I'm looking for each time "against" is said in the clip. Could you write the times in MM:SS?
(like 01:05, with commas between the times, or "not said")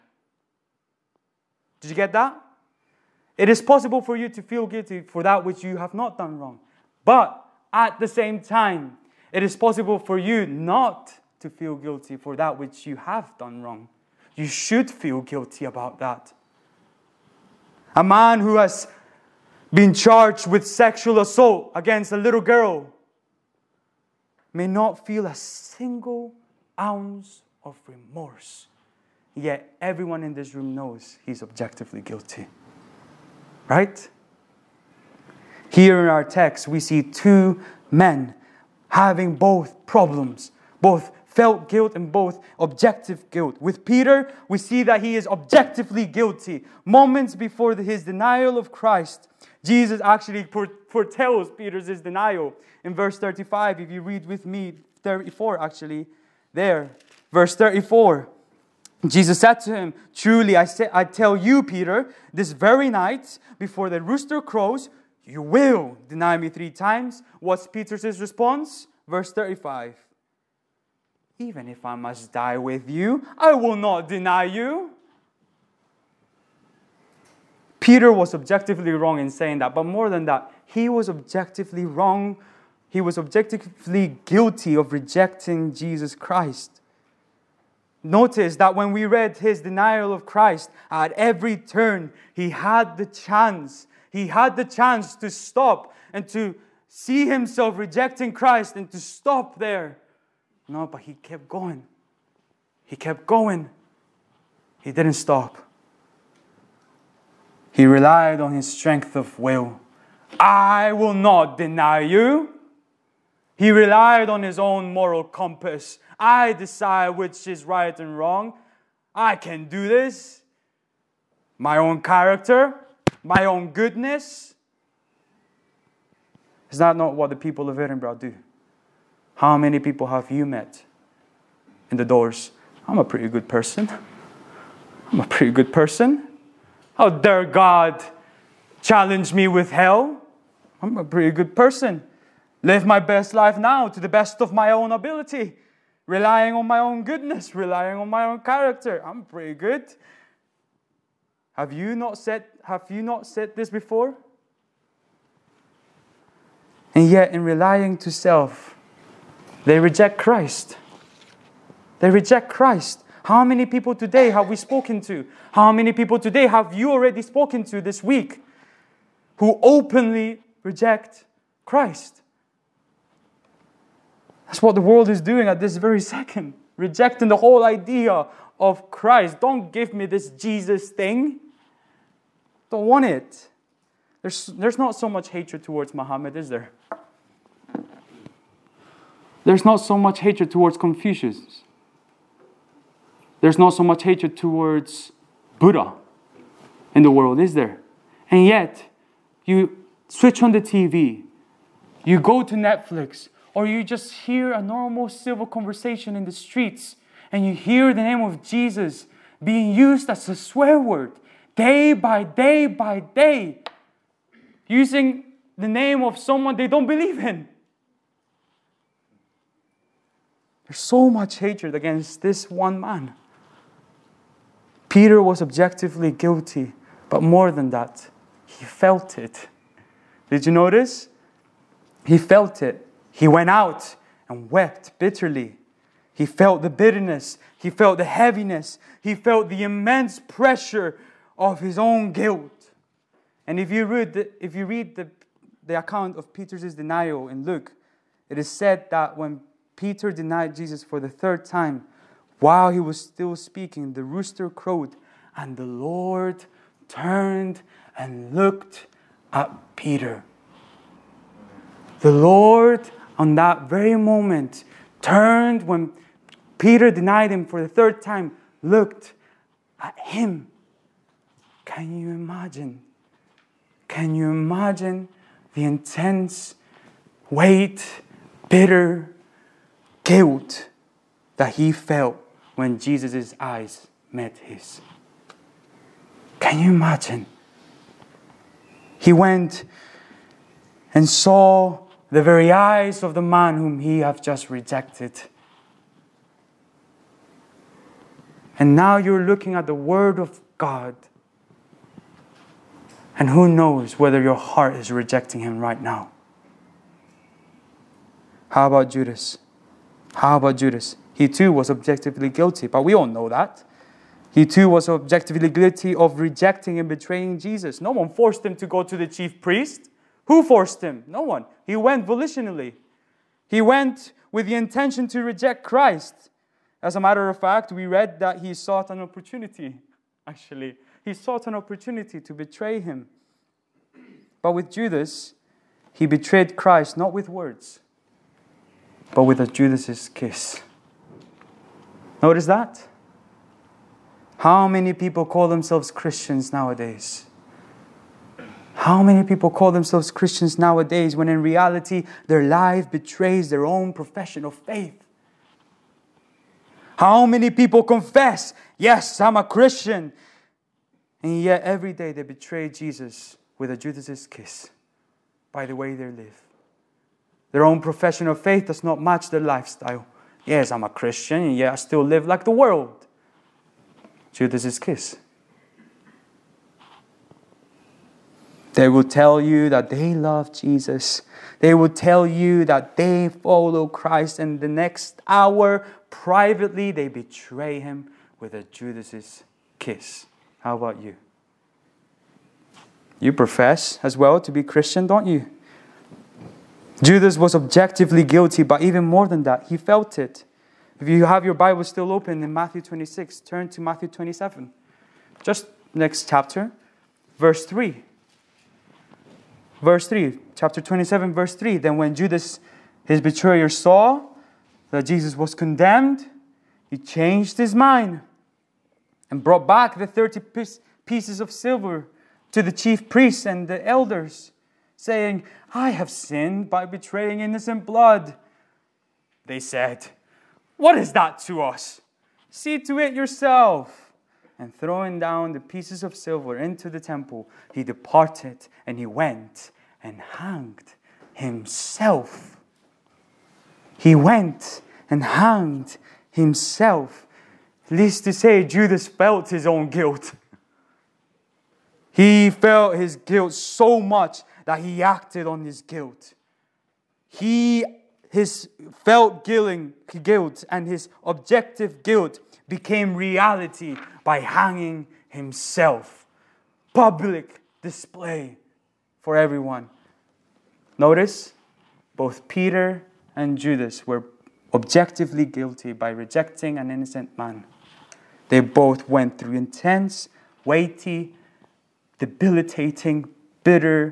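00:21, 03:41.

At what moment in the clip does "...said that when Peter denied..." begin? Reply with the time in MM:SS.
04:08.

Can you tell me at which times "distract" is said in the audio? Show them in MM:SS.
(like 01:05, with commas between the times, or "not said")
not said.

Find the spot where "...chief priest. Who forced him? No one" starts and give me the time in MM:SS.
05:19.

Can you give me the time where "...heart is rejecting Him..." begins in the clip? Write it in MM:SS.
05:04.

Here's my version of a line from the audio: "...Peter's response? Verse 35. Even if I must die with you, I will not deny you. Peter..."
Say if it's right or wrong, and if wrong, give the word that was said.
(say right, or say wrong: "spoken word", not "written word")
right.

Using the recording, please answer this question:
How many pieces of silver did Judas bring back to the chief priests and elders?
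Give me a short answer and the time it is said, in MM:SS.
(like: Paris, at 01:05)
30, at 07:00.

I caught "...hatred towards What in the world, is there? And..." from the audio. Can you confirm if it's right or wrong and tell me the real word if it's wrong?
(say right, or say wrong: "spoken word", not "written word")
wrong: "Buddha", not "What".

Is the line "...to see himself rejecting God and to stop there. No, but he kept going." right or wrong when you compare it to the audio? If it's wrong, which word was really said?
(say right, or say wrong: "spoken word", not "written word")
wrong: "Christ", not "God".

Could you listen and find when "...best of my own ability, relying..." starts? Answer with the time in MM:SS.
02:24.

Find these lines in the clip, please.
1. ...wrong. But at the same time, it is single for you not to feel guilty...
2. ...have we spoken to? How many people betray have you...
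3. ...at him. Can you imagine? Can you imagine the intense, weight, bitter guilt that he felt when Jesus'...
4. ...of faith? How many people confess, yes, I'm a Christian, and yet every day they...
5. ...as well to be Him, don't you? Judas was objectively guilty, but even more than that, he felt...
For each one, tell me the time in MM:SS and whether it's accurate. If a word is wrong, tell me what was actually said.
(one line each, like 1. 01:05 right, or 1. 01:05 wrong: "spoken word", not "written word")
1. 00:06 wrong: "possible", not "single"
2. 02:44 wrong: "today", not "betray"
3. 04:29 right
4. 05:54 right
5. 06:34 wrong: "Christian", not "Him".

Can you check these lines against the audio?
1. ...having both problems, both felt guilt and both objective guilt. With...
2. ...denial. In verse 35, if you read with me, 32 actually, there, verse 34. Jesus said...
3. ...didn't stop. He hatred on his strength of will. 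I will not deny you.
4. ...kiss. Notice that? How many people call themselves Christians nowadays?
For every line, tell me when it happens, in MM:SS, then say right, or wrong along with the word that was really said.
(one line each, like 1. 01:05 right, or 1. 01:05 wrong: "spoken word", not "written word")
1. 00:38 right
2. 00:52 wrong: "34", not "32"
3. 01:44 wrong: "relied", not "hatred"
4. 05:40 right.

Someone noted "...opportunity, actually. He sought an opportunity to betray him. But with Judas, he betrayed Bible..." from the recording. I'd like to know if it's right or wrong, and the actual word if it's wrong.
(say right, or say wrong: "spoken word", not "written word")
wrong: "Christ", not "Bible".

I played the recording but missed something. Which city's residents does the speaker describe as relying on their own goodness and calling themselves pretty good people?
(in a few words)
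Edinburgh.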